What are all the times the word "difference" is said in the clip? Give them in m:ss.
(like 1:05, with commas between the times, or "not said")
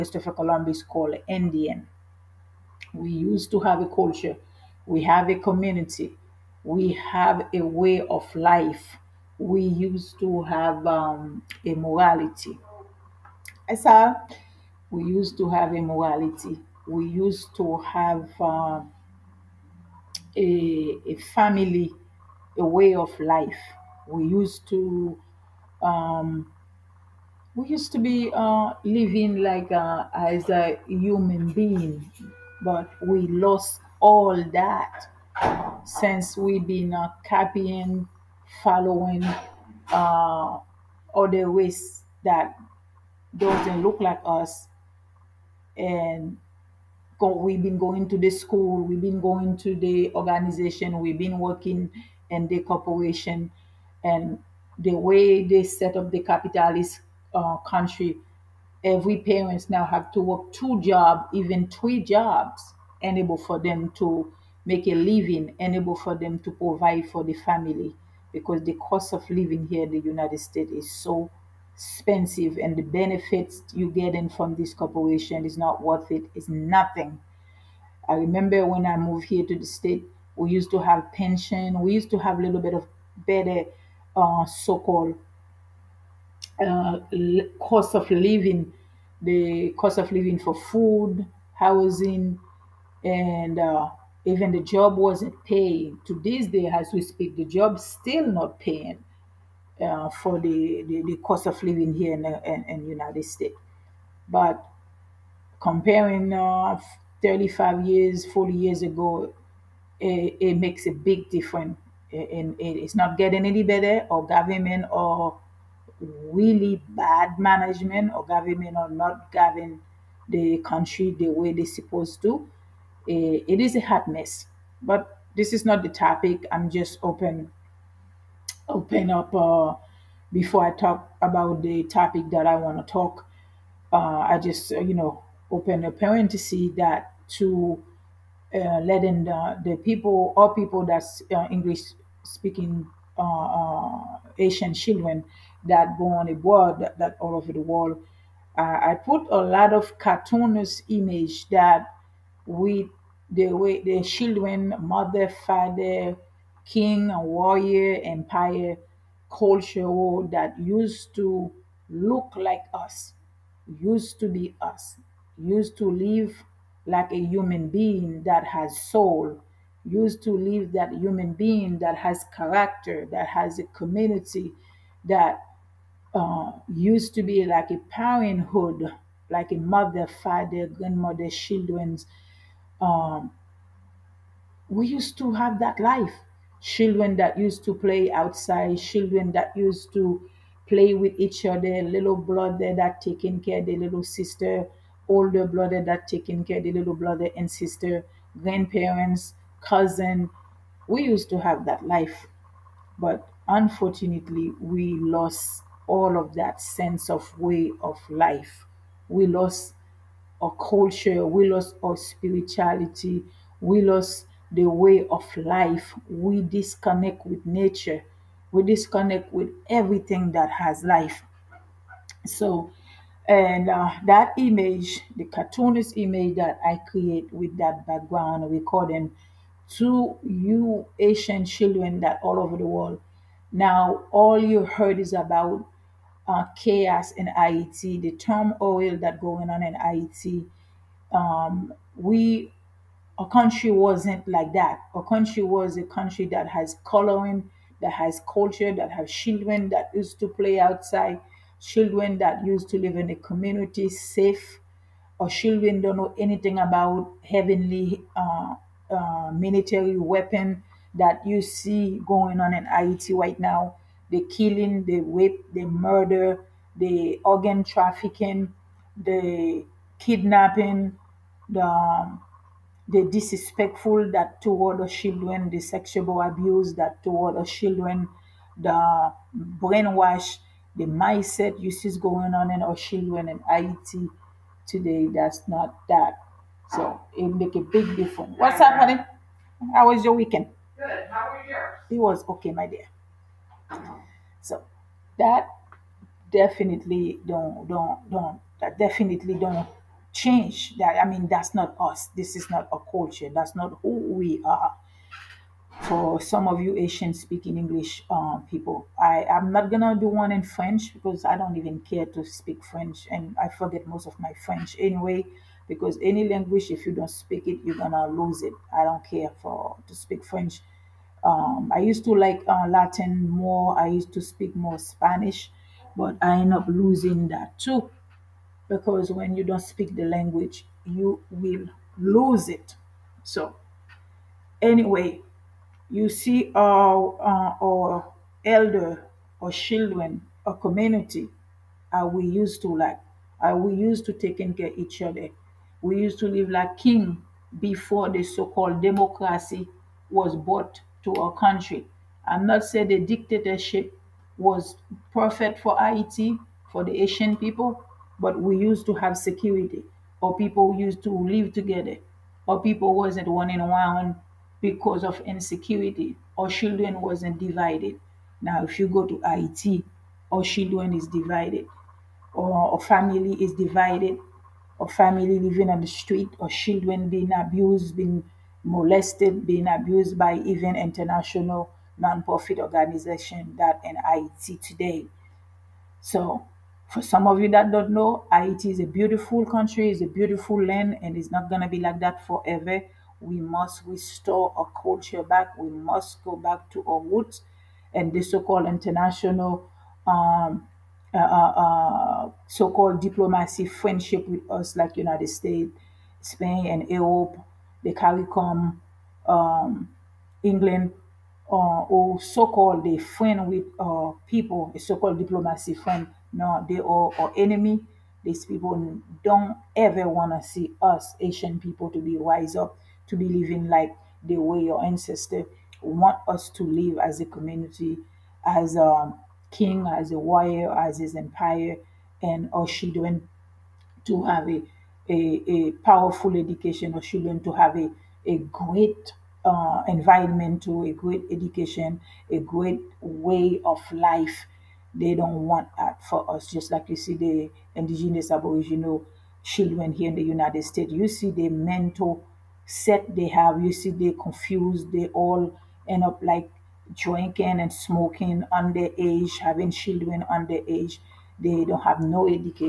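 1:51, 4:47.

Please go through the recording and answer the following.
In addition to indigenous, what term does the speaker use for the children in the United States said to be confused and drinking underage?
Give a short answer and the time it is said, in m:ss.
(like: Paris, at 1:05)
Aboriginal, at 7:28.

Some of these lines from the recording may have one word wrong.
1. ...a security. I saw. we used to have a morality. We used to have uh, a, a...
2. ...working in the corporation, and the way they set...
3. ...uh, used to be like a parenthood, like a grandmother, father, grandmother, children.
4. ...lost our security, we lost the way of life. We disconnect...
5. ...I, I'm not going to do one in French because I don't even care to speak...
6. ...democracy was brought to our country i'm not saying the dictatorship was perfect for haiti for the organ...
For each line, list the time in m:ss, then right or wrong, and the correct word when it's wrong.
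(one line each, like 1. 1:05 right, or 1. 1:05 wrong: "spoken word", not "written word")
1. 0:11 wrong: "morality", not "security"
2. 0:51 right
3. 2:56 wrong: "mother", not "grandmother"
4. 3:31 wrong: "spirituality", not "security"
5. 5:09 right
6. 5:48 wrong: "haitian", not "organ".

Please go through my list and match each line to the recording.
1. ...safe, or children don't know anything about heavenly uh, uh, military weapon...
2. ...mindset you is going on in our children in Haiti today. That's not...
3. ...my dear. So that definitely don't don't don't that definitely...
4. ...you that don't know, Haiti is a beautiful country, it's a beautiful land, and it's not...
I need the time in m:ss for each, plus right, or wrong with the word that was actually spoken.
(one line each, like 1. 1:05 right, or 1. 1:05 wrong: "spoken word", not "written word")
1. 4:13 right
2. 4:40 right
3. 4:52 right
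4. 6:27 right.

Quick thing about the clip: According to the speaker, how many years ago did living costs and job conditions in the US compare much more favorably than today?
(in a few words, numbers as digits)
35 years, 40 years.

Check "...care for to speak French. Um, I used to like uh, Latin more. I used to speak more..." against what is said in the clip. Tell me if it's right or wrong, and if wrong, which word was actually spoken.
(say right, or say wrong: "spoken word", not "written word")
right.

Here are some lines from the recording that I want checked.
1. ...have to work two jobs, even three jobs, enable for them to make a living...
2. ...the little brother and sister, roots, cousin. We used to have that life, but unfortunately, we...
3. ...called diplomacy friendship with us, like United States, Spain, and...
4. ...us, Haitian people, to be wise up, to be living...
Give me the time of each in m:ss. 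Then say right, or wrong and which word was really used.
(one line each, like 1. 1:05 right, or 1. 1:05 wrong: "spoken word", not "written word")
1. 0:59 right
2. 3:16 wrong: "grandparents", not "roots"
3. 6:42 right
4. 7:00 right.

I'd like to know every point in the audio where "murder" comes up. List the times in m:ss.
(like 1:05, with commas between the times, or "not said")
4:25.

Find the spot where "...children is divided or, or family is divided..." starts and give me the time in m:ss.
6:10.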